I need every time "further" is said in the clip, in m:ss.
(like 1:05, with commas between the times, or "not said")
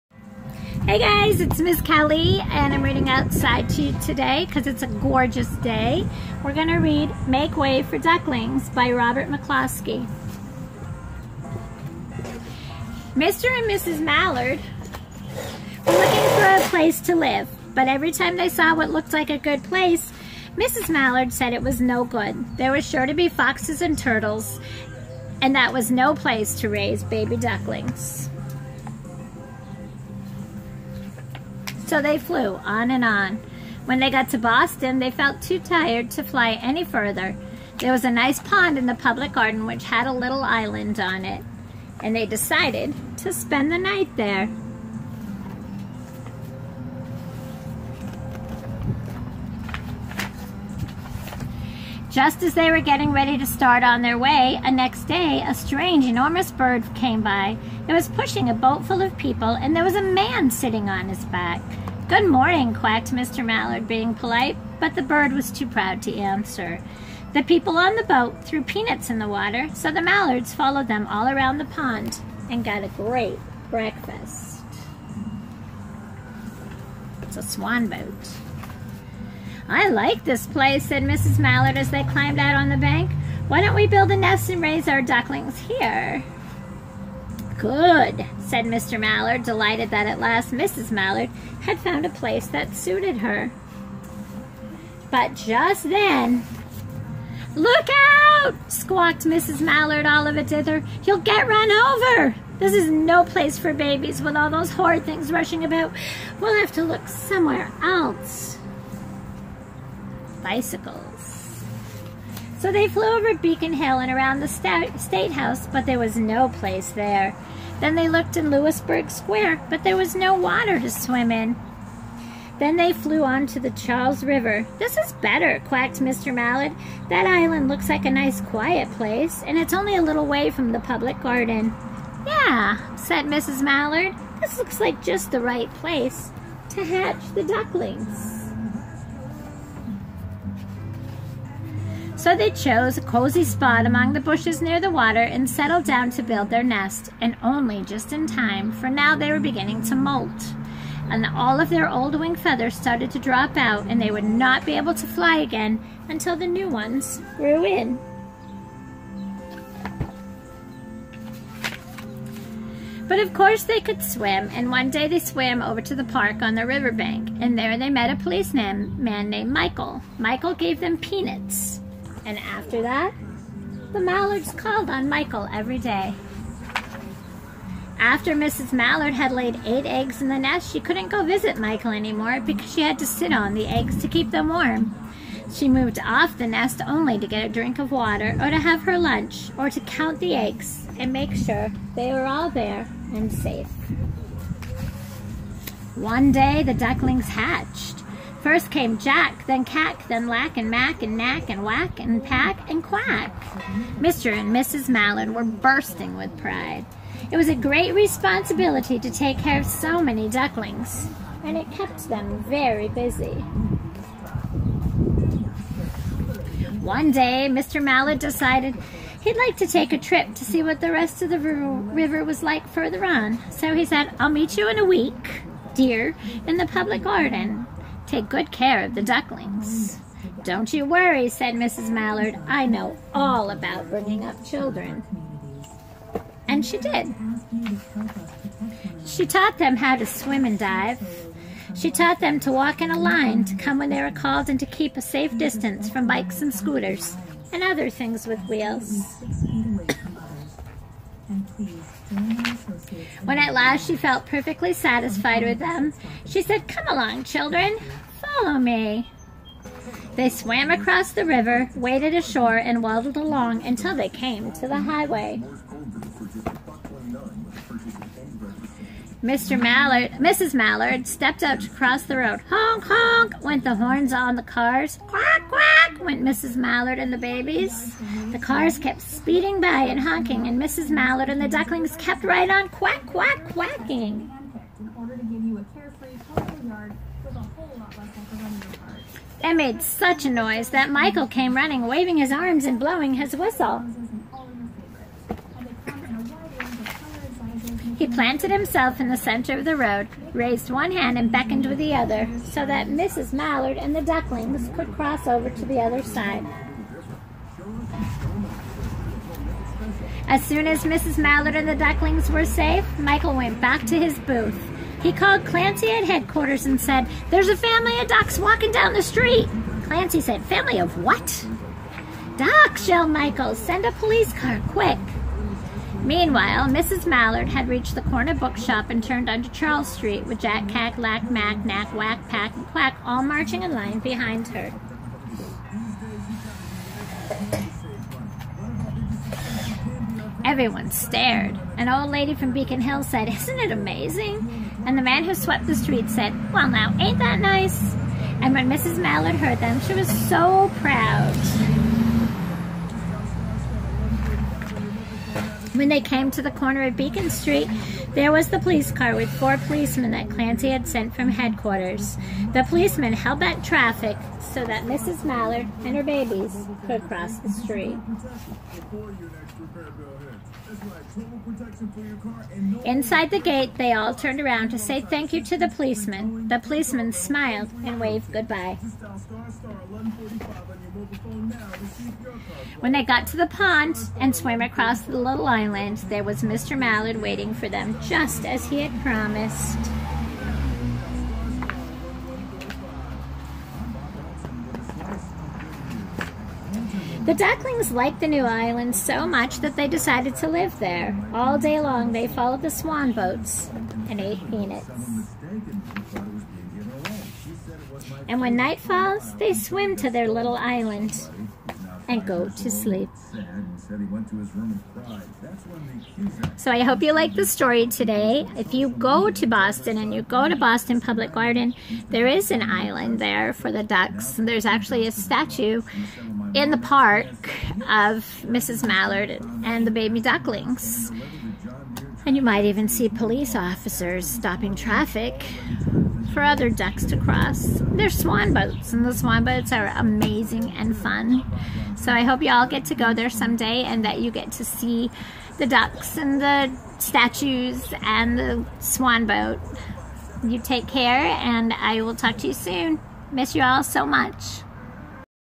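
0:36, 3:42.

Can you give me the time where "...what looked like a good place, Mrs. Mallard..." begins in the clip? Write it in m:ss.
0:18.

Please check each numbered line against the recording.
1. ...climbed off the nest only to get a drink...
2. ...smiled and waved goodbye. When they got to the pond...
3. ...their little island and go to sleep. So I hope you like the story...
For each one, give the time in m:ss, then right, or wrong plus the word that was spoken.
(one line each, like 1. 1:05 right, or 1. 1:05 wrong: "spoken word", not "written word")
1. 3:05 wrong: "moved", not "climbed"
2. 6:17 right
3. 6:50 right.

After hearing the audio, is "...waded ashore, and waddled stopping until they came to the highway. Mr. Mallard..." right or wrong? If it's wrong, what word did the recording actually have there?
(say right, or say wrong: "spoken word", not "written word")
wrong: "along", not "stopping".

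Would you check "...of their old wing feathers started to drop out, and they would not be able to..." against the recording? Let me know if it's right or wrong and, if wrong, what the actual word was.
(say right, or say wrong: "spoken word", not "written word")
right.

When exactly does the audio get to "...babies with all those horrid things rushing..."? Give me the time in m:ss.
1:43.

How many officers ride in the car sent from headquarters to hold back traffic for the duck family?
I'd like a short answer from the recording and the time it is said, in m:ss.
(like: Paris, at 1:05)
4, at 5:59.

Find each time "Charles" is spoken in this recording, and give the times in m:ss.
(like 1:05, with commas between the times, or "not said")
2:03, 5:29.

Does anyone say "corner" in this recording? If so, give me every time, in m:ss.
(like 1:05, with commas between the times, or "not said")
5:28, 5:56.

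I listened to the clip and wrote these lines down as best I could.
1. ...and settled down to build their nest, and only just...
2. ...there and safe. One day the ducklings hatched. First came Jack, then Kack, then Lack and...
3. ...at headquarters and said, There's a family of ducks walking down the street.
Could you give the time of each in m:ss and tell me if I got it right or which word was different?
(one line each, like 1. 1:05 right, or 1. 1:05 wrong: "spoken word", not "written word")
1. 2:25 right
2. 3:12 right
3. 5:15 right.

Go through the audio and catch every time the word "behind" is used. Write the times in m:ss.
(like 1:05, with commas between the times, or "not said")
5:33.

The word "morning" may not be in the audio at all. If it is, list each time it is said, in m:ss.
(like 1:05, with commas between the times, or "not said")
1:02.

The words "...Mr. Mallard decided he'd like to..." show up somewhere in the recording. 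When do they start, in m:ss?
3:37.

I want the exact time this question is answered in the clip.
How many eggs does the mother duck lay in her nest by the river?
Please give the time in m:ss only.
2:59.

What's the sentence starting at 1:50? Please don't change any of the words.
Bicycles so they flew over Beacon Hill and around the State House, but there was no place there.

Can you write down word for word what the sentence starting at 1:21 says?
Mallard as they climbed out on the bank.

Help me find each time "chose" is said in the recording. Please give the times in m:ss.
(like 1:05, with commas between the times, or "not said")
2:22.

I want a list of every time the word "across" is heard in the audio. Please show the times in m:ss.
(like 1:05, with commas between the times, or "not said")
4:20, 6:24.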